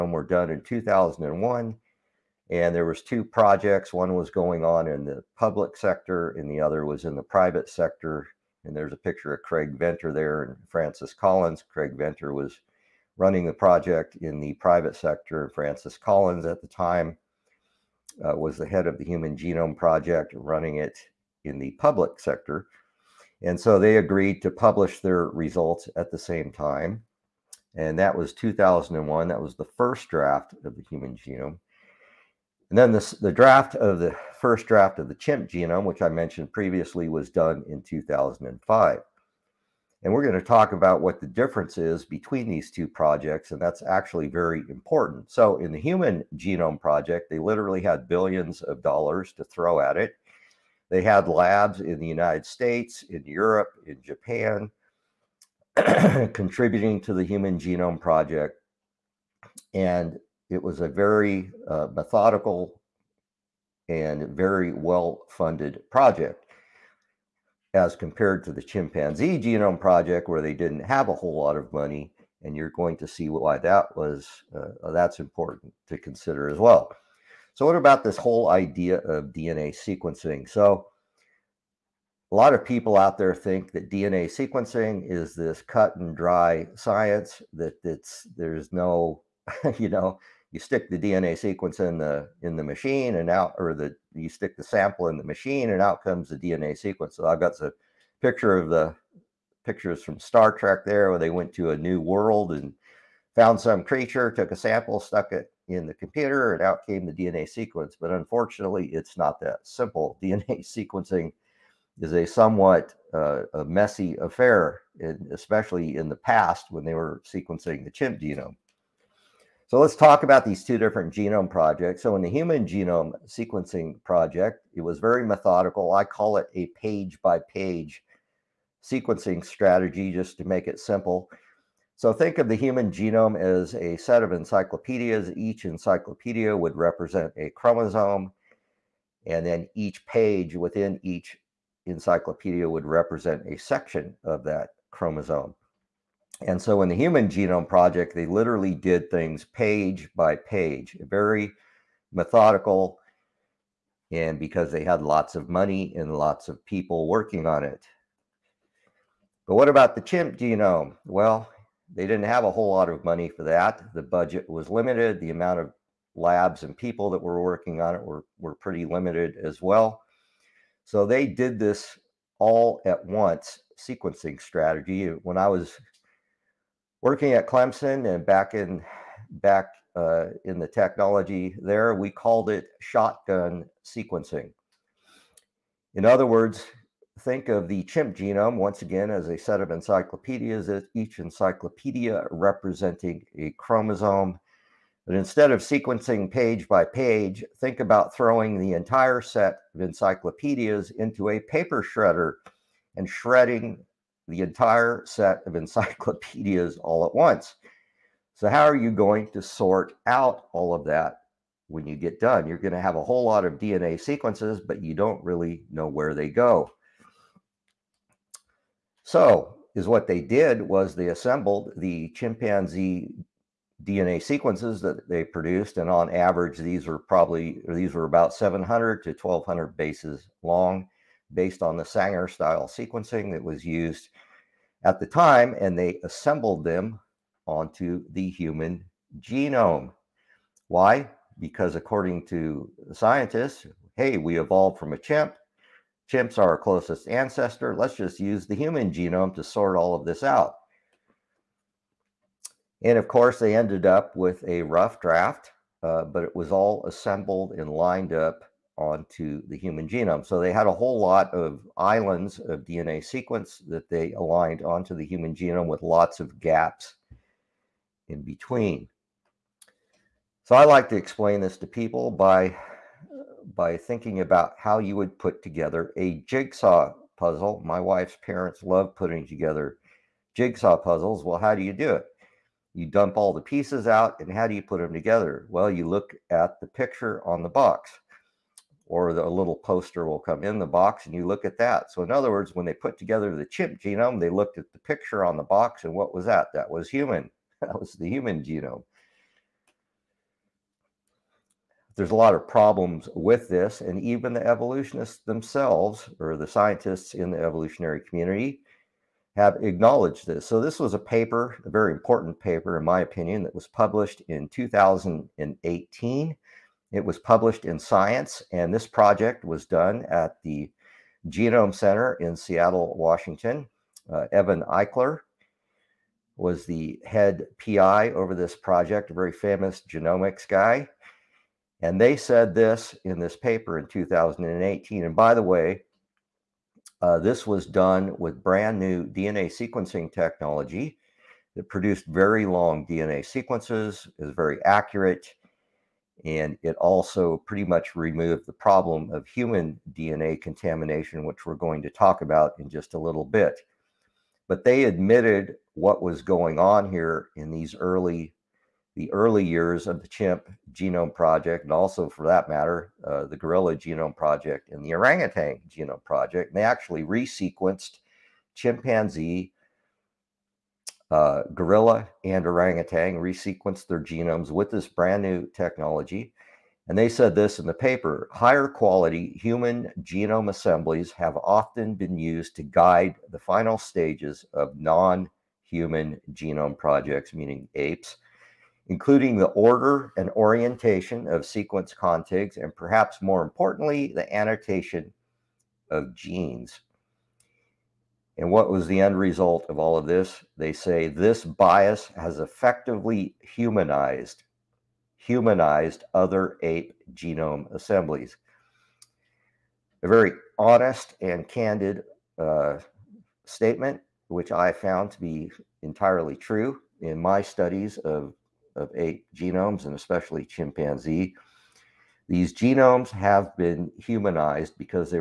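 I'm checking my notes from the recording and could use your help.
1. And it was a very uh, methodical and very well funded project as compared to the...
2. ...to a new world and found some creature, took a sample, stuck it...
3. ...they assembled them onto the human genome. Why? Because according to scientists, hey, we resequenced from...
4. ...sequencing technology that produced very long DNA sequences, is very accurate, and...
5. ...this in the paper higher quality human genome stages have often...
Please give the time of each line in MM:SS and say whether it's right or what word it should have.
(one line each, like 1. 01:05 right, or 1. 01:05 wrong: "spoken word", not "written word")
1. 00:59 right
2. 01:41 right
3. 03:55 wrong: "evolved", not "resequenced"
4. 05:39 right
5. 06:17 wrong: "assemblies", not "stages".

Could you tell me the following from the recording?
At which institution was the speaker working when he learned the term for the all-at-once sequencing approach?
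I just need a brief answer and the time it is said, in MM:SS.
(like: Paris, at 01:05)
Clemson, at 02:57.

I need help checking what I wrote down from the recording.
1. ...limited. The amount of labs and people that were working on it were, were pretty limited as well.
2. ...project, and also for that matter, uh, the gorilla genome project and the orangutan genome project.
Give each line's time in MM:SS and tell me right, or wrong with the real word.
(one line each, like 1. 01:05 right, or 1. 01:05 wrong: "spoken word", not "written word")
1. 02:44 right
2. 06:01 right.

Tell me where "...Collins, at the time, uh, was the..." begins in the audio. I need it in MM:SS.
00:15.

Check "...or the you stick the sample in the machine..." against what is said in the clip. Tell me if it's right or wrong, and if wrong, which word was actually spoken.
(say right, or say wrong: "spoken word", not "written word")
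right.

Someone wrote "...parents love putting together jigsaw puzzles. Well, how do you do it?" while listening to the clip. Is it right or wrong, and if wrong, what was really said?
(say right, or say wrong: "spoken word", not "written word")
right.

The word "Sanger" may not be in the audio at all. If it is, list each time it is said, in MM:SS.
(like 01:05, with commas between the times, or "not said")
03:51.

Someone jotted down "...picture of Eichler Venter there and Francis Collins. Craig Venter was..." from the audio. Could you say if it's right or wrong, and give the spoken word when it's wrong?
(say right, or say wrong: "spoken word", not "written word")
wrong: "Craig", not "Eichler".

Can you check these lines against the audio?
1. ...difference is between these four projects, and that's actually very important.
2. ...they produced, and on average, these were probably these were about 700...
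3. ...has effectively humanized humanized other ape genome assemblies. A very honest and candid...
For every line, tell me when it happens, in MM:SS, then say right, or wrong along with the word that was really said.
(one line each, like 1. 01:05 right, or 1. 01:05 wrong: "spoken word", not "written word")
1. 00:41 wrong: "two", not "four"
2. 03:45 right
3. 06:42 right.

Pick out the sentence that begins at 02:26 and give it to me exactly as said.
And so in the Human Genome Project, they literally did things page by page, very methodical.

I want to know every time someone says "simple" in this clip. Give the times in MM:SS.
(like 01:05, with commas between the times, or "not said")
01:49, 02:10.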